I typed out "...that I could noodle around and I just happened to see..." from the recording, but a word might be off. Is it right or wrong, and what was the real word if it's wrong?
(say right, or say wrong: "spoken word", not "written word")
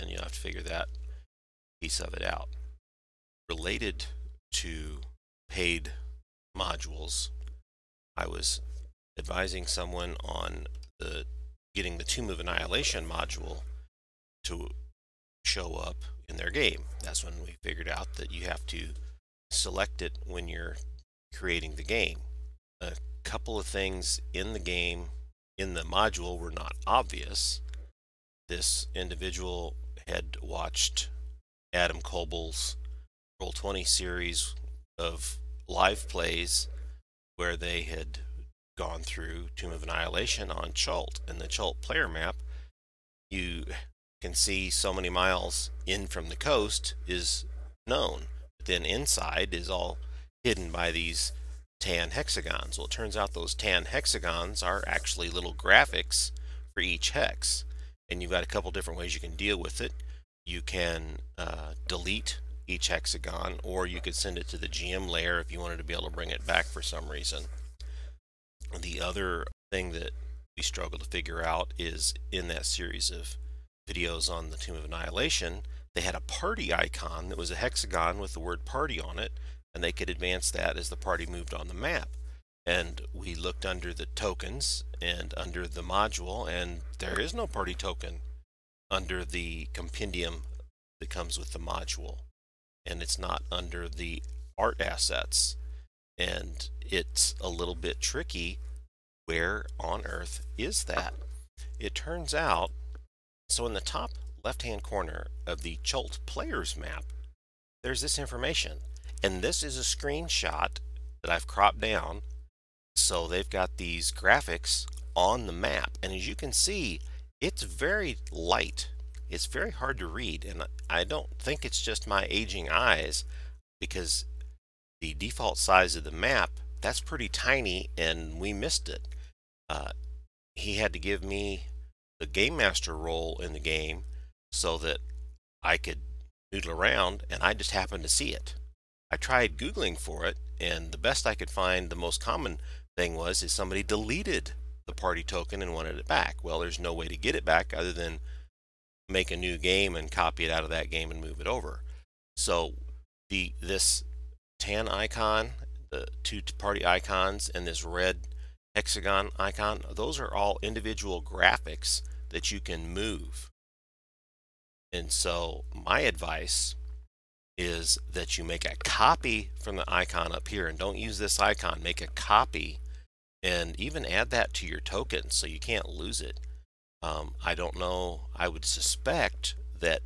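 right.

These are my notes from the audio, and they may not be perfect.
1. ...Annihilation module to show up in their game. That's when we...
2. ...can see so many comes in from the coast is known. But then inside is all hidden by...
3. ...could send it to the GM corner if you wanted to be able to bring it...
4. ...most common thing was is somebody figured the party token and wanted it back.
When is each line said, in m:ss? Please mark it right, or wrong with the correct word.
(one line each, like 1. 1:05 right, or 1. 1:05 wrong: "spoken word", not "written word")
1. 0:12 right
2. 0:44 wrong: "miles", not "comes"
3. 1:04 wrong: "layer", not "corner"
4. 2:21 wrong: "deleted", not "figured".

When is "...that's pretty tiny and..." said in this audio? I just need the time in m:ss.
2:06.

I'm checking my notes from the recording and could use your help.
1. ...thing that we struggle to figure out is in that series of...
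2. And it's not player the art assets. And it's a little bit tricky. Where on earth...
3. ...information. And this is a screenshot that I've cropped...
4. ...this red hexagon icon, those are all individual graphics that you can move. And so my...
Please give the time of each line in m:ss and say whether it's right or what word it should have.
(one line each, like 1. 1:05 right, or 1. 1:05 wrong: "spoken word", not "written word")
1. 1:09 right
2. 1:32 wrong: "under", not "player"
3. 1:48 right
4. 2:37 right.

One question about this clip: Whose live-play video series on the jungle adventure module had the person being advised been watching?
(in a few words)
Adam Koebel.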